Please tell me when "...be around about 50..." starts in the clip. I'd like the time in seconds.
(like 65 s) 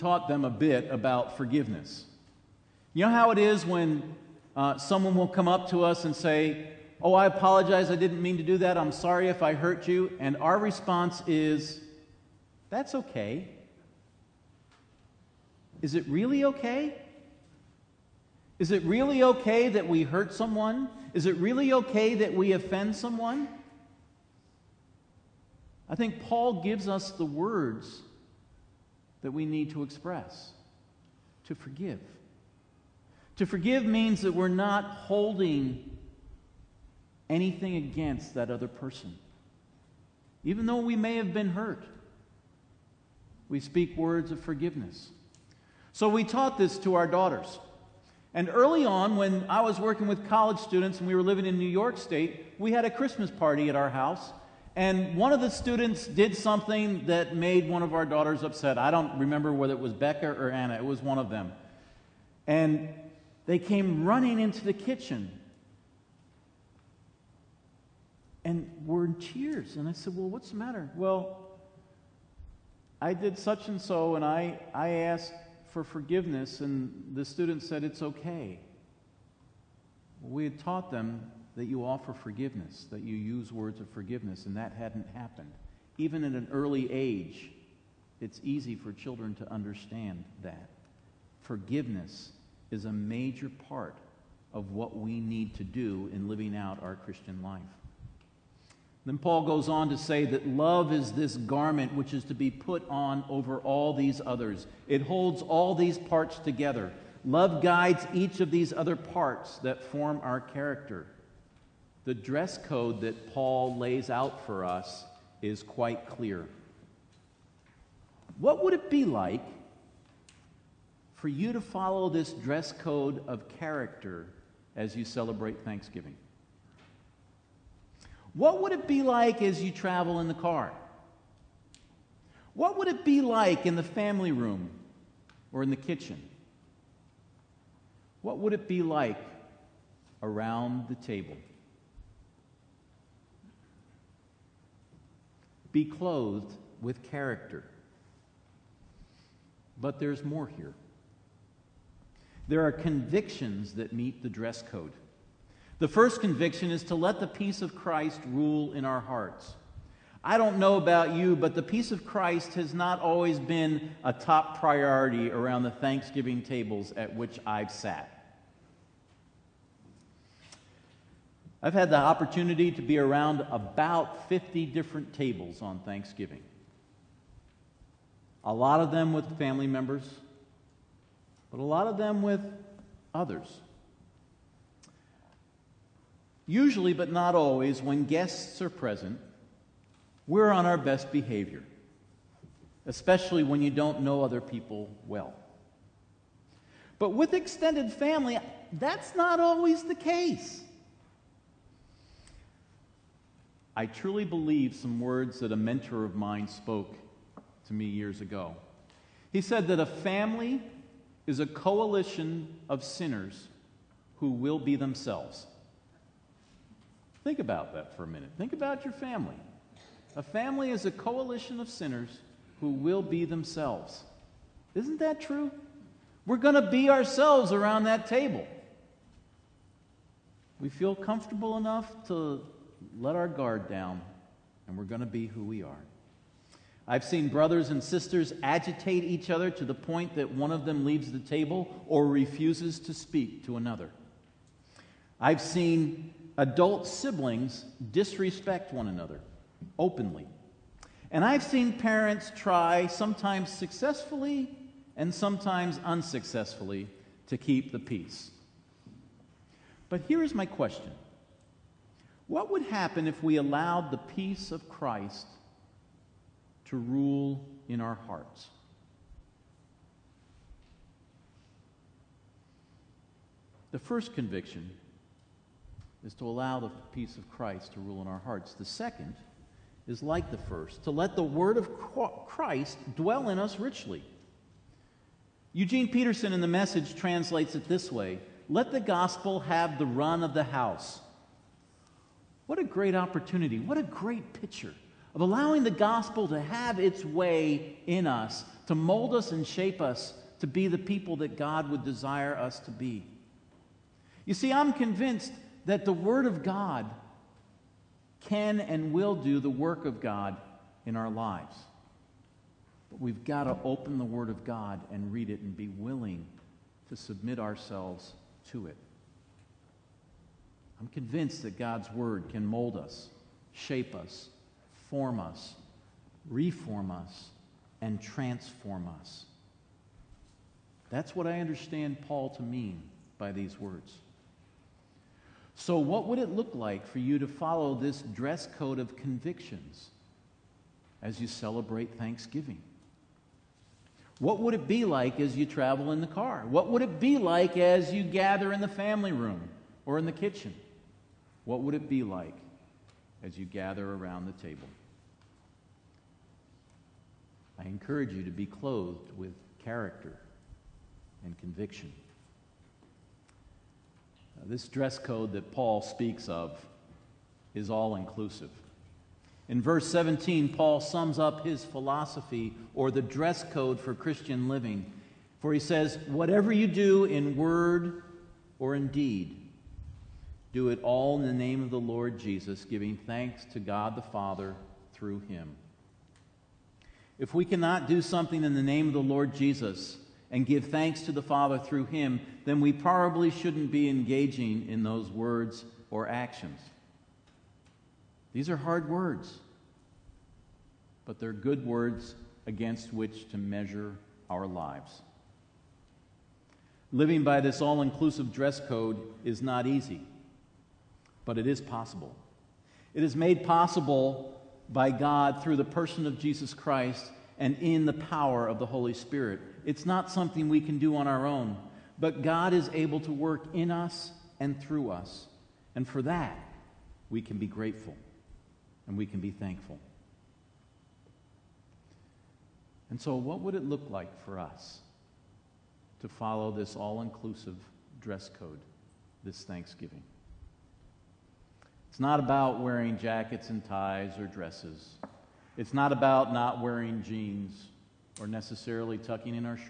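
172 s.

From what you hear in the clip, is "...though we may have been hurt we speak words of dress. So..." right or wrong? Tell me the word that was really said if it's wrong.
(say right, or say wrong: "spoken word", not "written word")
wrong: "forgiveness", not "dress".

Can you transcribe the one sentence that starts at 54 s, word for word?
And one of the students did something that made one of our daughters upset.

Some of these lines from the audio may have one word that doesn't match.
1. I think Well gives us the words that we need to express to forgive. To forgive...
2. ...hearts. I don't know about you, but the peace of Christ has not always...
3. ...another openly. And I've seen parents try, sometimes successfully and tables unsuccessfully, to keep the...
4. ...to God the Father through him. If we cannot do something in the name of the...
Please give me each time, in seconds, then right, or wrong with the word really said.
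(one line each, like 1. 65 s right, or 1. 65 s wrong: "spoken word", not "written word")
1. 25 s wrong: "Paul", not "Well"
2. 158 s right
3. 248 s wrong: "sometimes", not "tables"
4. 383 s right.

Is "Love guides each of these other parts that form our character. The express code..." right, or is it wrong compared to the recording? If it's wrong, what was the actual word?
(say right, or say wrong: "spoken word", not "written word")
wrong: "dress", not "express".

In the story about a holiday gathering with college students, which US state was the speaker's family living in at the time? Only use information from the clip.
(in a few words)
New York State.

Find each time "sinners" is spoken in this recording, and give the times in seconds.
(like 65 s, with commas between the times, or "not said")
212 s, 221 s.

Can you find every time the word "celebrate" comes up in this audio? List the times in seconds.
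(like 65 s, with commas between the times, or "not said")
125 s, 341 s.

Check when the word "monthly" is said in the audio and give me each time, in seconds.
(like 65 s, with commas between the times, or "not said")
not said.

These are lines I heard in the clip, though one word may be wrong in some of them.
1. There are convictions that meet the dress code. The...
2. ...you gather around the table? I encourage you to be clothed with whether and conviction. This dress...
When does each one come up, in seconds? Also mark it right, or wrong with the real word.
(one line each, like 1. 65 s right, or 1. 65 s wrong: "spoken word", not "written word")
1. 152 s right
2. 353 s wrong: "character", not "whether".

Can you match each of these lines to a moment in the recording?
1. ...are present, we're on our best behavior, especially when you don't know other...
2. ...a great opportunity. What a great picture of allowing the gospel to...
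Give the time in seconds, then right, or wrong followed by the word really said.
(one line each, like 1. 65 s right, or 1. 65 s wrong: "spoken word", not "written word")
1. 188 s right
2. 292 s right.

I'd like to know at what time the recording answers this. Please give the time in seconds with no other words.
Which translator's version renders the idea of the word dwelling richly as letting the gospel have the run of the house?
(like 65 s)
285 s.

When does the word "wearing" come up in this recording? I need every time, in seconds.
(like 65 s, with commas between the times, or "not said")
442 s, 446 s.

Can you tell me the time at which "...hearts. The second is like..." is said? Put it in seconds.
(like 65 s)
278 s.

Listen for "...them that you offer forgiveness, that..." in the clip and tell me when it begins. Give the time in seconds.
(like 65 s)
80 s.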